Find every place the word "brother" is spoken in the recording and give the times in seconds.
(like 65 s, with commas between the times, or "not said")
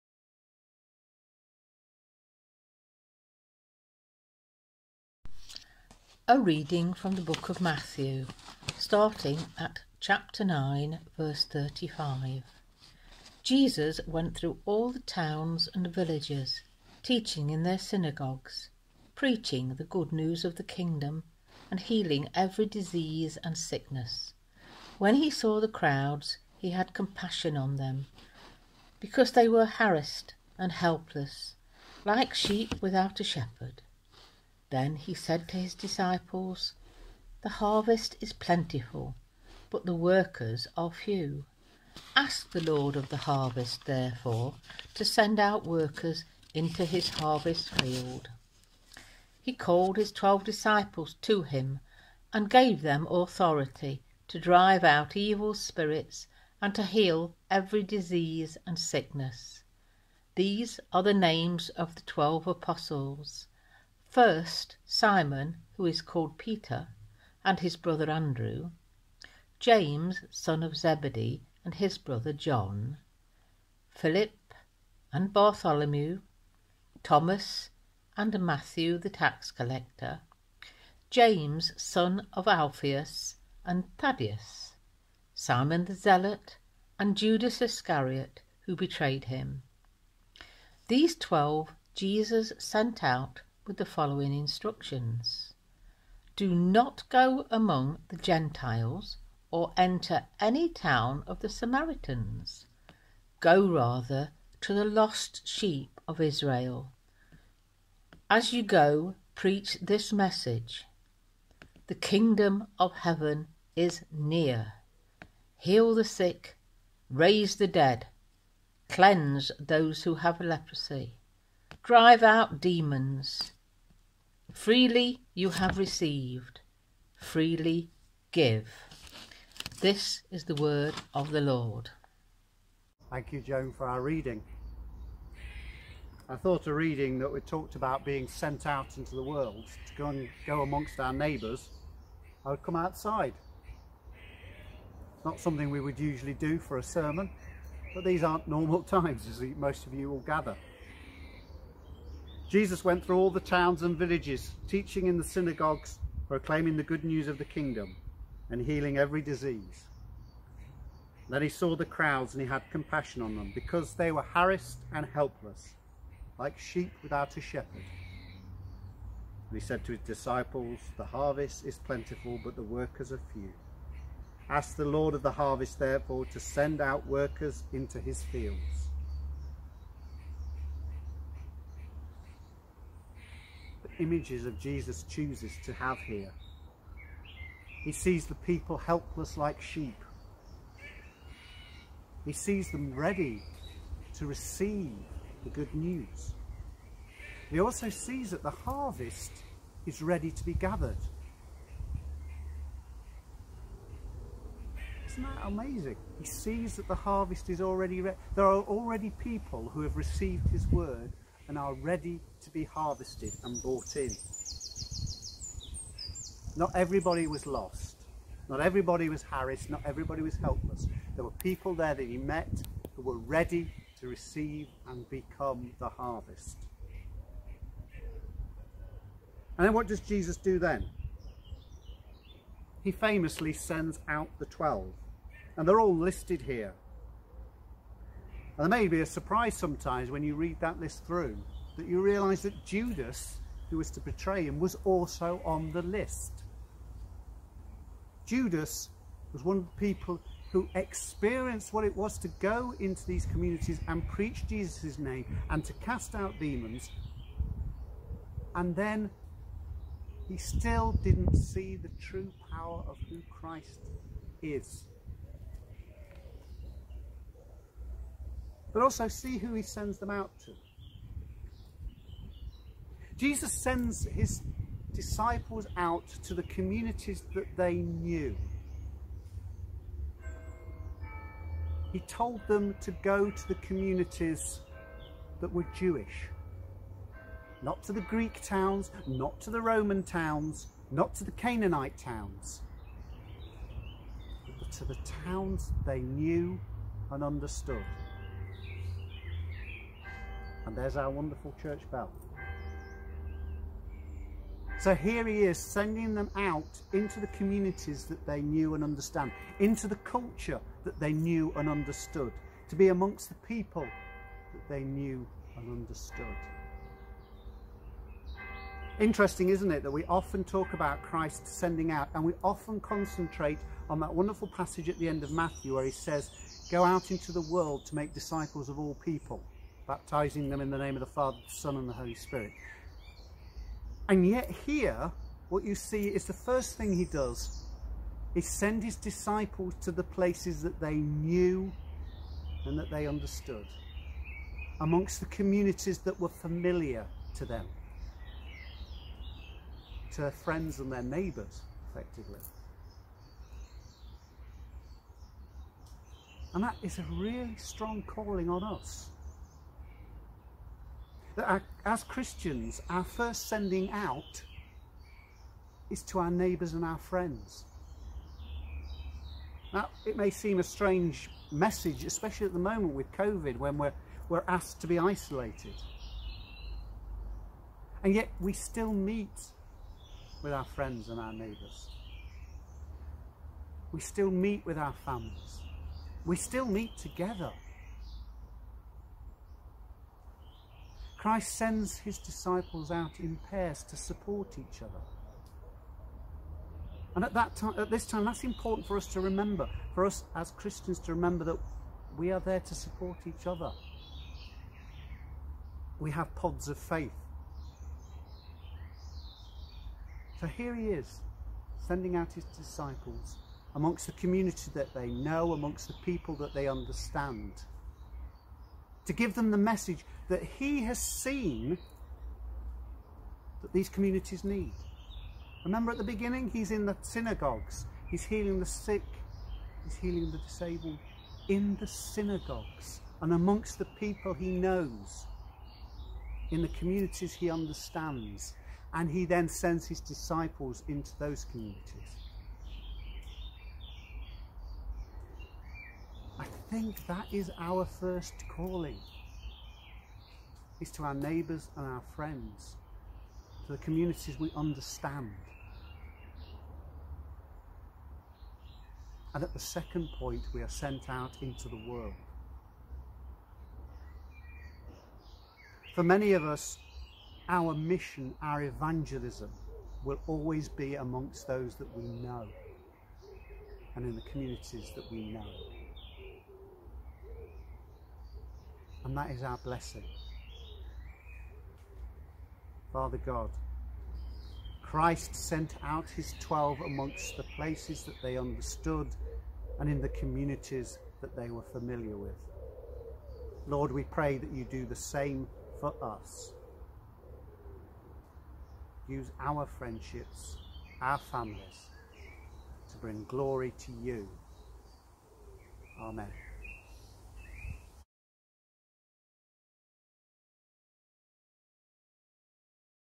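67 s, 71 s.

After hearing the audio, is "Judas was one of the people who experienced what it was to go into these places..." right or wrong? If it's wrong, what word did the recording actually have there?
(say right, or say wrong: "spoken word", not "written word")
wrong: "communities", not "places".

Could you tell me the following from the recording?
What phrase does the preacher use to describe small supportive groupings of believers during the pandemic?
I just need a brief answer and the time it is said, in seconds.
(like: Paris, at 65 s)
pods of faith, at 406 s.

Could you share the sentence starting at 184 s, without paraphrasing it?
images of Jesus chooses to have here.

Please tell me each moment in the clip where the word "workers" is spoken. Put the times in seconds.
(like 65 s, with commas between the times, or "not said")
39 s, 45 s, 172 s, 177 s.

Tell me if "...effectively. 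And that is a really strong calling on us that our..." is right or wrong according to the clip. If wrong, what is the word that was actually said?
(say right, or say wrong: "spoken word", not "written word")
right.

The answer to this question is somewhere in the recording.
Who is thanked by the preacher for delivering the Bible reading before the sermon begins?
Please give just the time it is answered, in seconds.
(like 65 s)
133 s.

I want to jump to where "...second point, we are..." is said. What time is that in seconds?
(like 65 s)
459 s.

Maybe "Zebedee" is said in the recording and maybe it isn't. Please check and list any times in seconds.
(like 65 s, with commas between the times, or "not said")
70 s.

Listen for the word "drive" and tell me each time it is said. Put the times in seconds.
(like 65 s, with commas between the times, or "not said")
54 s, 121 s.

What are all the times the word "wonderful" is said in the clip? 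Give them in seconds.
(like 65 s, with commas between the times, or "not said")
301 s, 324 s.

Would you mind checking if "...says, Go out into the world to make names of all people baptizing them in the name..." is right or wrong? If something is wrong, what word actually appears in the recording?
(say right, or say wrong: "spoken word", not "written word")
wrong: "disciples", not "names".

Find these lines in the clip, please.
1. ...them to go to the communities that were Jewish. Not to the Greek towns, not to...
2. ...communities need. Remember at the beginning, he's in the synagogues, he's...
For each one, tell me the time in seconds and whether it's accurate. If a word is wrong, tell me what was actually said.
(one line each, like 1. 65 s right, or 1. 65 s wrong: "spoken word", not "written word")
1. 282 s right
2. 423 s right.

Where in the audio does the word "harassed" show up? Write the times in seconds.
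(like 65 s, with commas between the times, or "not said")
29 s, 164 s, 219 s.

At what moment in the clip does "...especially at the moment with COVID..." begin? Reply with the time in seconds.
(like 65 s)
372 s.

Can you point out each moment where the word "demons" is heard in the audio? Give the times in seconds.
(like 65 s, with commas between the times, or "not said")
122 s, 256 s.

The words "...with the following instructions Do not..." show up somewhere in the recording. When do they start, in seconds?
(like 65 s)
93 s.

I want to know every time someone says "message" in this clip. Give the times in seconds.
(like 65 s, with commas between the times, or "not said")
110 s, 371 s, 419 s.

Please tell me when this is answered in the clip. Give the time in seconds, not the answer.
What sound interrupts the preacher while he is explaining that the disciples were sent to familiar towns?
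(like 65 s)
301 s.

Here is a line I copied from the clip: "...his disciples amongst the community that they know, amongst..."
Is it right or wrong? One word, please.
right.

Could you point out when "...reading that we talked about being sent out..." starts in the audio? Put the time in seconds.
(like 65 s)
136 s.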